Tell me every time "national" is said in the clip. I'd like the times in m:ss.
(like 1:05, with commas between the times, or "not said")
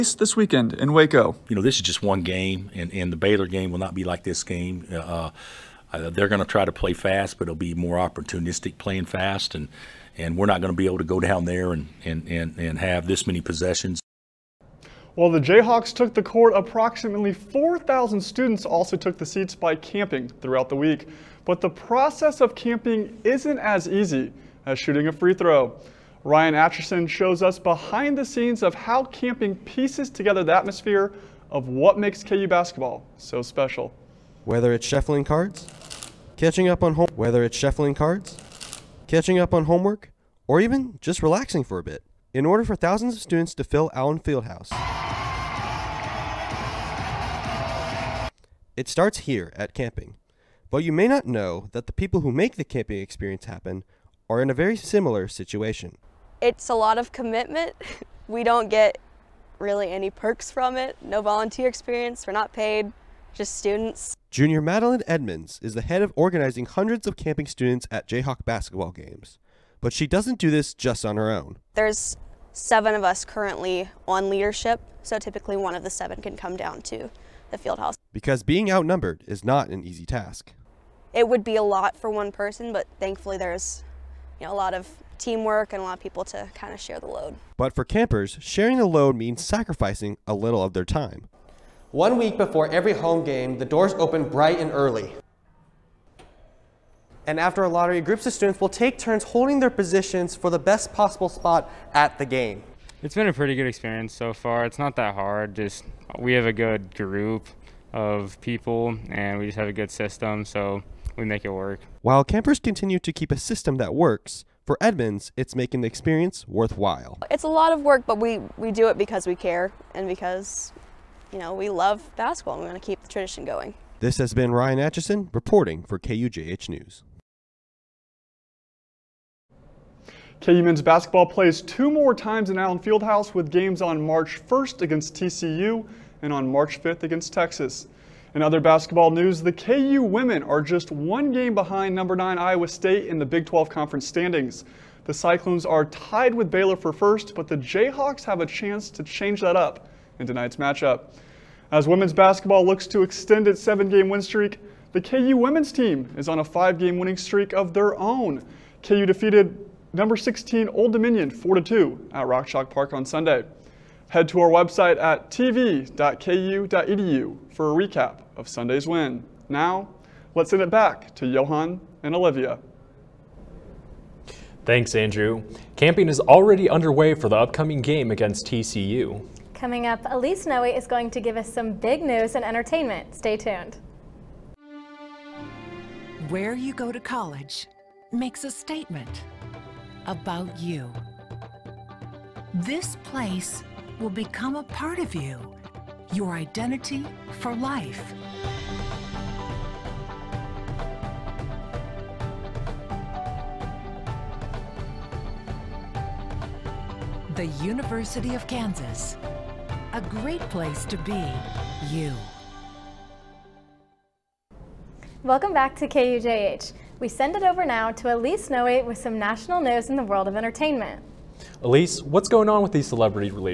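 3:39.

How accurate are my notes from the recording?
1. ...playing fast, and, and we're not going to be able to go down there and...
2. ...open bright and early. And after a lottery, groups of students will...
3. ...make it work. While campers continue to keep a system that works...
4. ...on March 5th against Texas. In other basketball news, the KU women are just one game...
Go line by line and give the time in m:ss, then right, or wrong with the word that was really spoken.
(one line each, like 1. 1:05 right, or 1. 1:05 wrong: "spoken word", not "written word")
1. 0:08 right
2. 1:33 right
3. 1:51 right
4. 2:16 right.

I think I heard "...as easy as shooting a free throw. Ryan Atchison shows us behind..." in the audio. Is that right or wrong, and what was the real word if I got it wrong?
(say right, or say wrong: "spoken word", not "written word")
right.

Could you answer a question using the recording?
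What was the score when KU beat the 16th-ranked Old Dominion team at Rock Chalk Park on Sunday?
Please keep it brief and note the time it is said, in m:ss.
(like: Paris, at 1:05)
4-2, at 2:41.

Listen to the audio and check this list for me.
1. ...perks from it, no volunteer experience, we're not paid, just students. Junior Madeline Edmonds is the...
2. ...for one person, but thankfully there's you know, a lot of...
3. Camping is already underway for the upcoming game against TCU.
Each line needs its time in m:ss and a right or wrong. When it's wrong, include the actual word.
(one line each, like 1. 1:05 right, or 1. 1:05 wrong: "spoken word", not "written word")
1. 1:00 right
2. 1:21 right
3. 2:55 right.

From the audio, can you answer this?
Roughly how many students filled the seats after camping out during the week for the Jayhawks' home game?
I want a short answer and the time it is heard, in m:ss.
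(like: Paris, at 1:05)
4,000, at 0:17.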